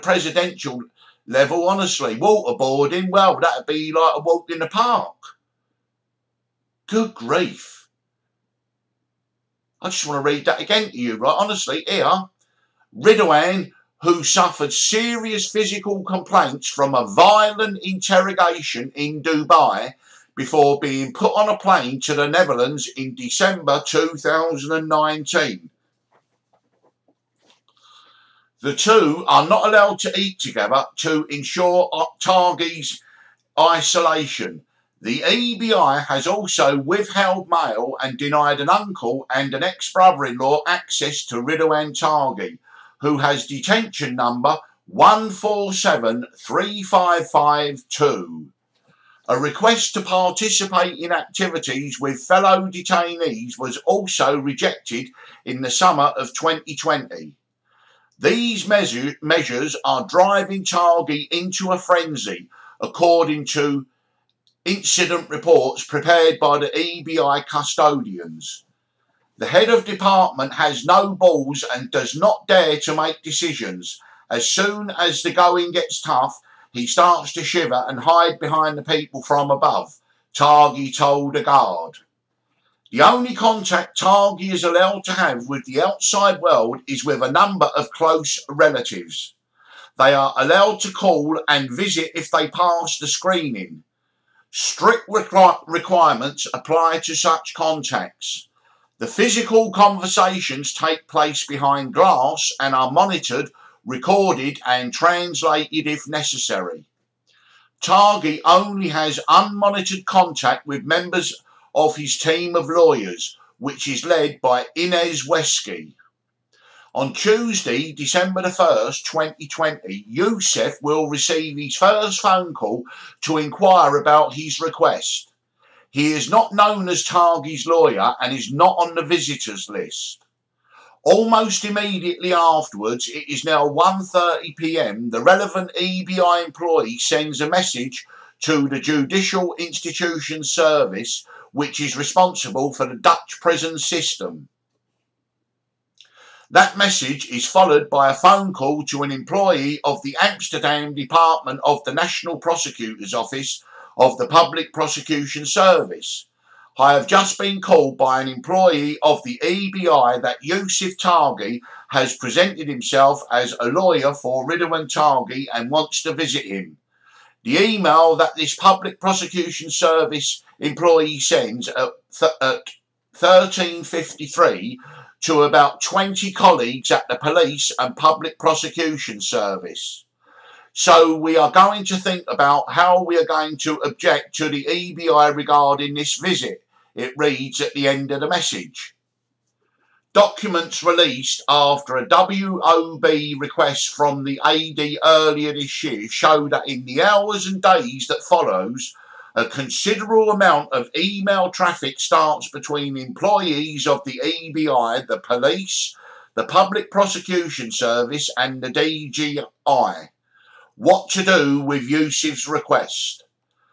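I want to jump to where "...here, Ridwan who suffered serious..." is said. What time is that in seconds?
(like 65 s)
11 s.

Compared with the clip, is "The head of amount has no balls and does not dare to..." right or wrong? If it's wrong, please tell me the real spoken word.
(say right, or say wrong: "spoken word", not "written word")
wrong: "department", not "amount".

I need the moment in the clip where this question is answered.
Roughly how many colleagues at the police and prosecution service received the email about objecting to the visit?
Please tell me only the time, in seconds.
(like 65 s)
175 s.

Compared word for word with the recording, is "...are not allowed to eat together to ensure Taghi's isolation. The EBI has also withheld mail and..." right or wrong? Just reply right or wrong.
right.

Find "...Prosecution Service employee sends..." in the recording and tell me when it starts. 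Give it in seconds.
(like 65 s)
168 s.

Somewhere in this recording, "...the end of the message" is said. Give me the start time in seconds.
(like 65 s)
187 s.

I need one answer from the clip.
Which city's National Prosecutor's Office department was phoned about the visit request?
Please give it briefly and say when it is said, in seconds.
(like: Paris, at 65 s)
Amsterdam, at 150 s.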